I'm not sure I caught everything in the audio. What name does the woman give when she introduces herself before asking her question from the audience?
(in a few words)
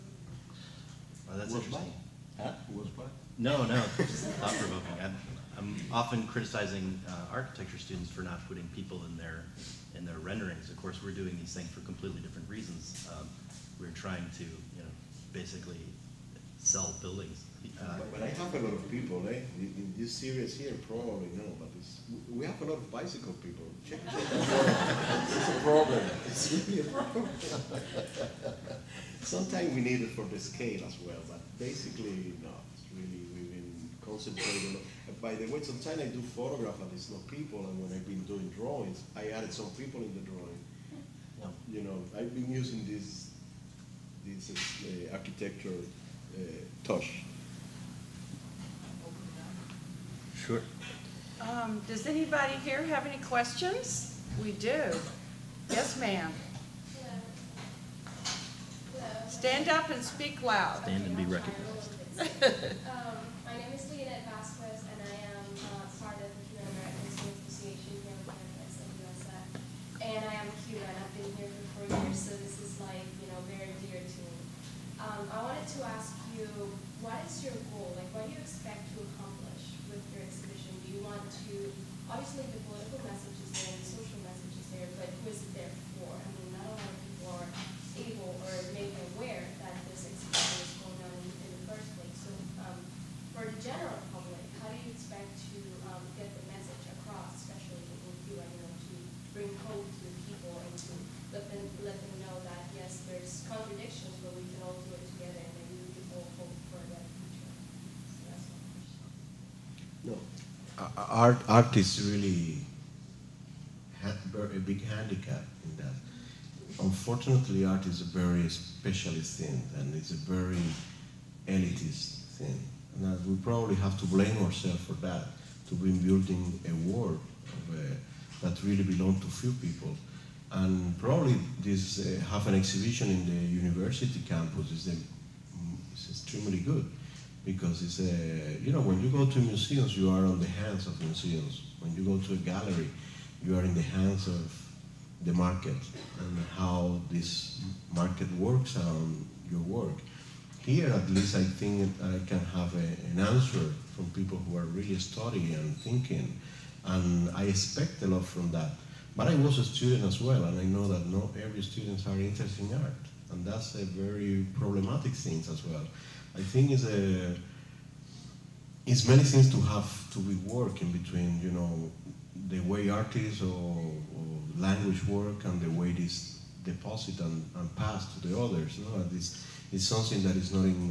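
Leonette Vasquez.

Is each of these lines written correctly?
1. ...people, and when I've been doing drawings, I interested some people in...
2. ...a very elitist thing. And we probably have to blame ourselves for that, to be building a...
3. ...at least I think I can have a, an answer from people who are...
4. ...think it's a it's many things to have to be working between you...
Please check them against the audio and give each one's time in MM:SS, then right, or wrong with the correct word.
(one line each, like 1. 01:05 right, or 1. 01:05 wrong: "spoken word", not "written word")
1. 00:37 wrong: "added", not "interested"
2. 02:00 right
3. 02:30 right
4. 02:46 right.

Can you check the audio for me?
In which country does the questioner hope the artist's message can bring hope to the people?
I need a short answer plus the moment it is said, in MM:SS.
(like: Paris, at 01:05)
Cuba, at 01:38.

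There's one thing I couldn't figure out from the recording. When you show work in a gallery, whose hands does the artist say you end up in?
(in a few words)
the market.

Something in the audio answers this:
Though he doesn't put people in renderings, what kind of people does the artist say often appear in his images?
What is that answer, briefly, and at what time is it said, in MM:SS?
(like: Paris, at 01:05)
bicycle people, at 00:22.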